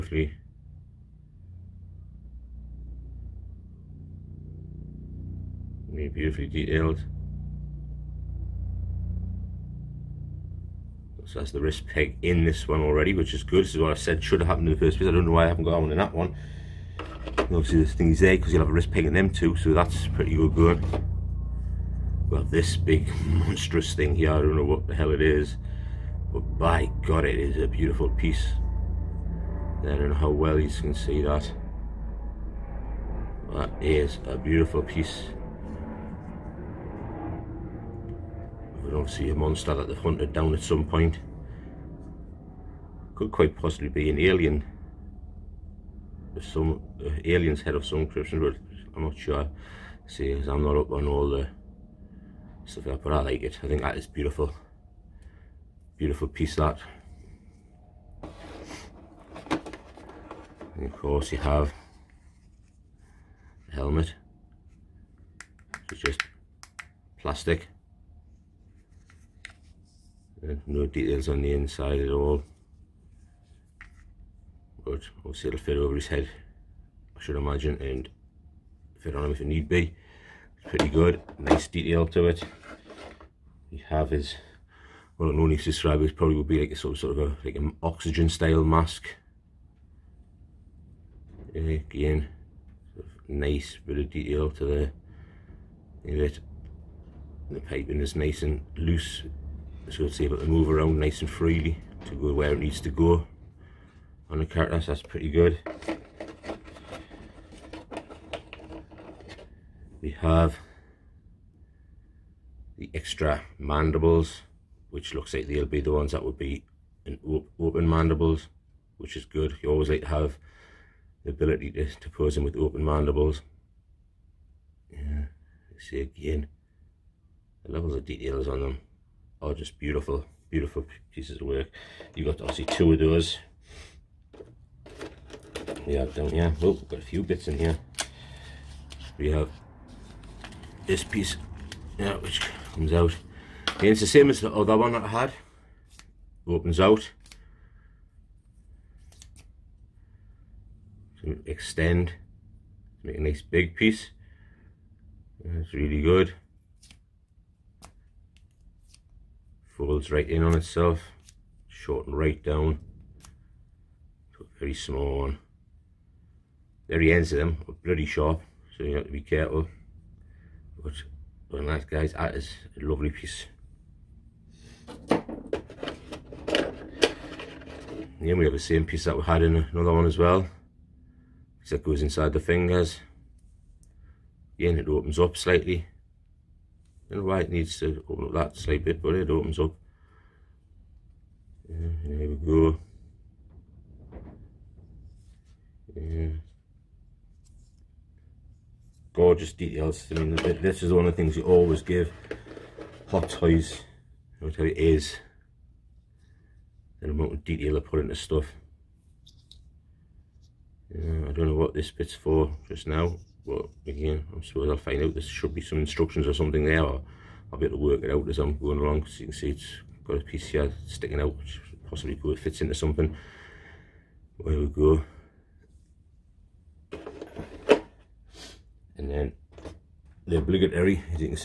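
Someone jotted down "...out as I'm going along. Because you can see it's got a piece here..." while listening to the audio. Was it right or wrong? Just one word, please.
right.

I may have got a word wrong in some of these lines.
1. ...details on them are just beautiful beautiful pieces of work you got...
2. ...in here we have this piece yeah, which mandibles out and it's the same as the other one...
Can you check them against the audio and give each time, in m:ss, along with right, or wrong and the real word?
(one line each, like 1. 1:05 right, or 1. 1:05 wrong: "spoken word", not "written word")
1. 2:08 right
2. 2:17 wrong: "comes", not "mandibles".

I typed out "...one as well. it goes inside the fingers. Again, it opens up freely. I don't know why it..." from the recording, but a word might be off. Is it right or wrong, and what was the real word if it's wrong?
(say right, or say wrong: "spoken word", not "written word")
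wrong: "slightly", not "freely".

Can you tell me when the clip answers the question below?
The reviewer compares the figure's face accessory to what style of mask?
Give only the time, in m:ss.
1:27.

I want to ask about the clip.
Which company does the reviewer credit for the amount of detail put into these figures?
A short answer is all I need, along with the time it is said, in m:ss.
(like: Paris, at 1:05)
Hot Toys, at 3:23.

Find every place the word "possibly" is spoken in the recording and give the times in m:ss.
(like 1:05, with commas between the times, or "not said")
0:43, 3:41.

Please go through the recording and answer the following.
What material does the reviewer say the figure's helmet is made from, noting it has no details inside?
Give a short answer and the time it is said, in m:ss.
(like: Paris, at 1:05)
Plastic, at 1:07.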